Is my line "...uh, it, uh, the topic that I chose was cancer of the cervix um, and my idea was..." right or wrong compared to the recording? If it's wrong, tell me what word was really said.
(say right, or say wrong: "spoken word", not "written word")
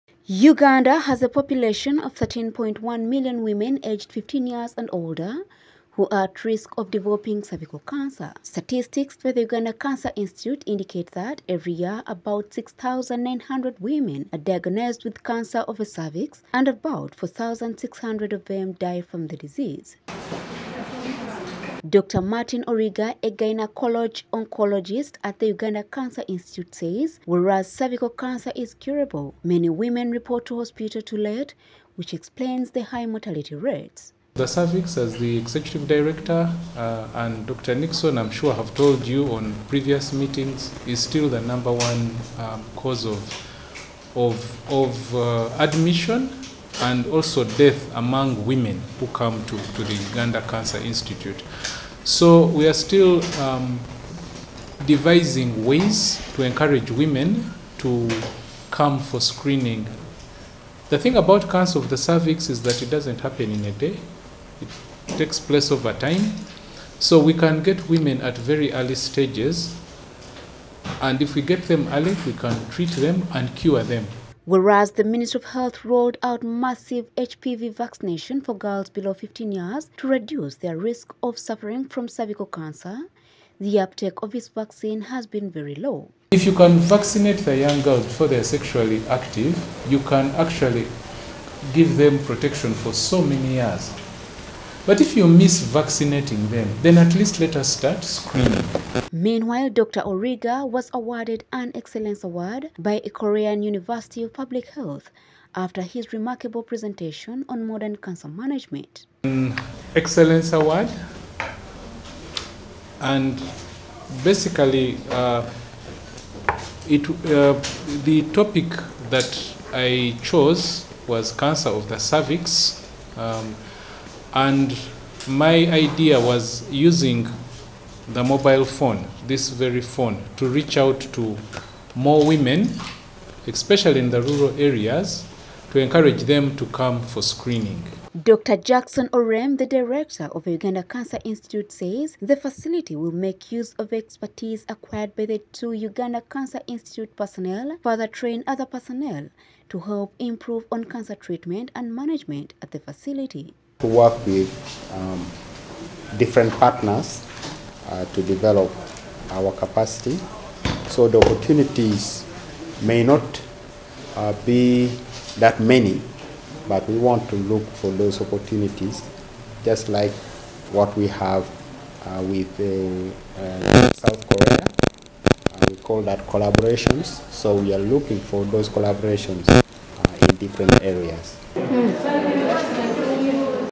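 right.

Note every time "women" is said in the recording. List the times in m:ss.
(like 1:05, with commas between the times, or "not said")
0:03, 0:13, 0:29, 0:48, 0:56, 1:07, 2:12.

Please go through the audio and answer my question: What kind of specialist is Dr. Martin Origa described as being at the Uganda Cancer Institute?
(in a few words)
Gynecologist oncologist.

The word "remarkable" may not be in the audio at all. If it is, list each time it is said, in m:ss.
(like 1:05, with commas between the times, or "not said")
1:46.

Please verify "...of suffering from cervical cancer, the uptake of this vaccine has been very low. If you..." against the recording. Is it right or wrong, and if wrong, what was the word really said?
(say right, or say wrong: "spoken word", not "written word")
right.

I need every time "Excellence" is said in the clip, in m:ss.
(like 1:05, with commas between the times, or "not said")
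1:41, 1:49.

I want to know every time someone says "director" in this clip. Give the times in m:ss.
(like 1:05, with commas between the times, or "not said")
0:35, 2:19.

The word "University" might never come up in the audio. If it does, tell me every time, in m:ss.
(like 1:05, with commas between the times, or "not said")
1:43.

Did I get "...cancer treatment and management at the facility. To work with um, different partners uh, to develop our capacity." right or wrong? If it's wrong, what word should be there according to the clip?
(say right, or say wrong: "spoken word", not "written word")
right.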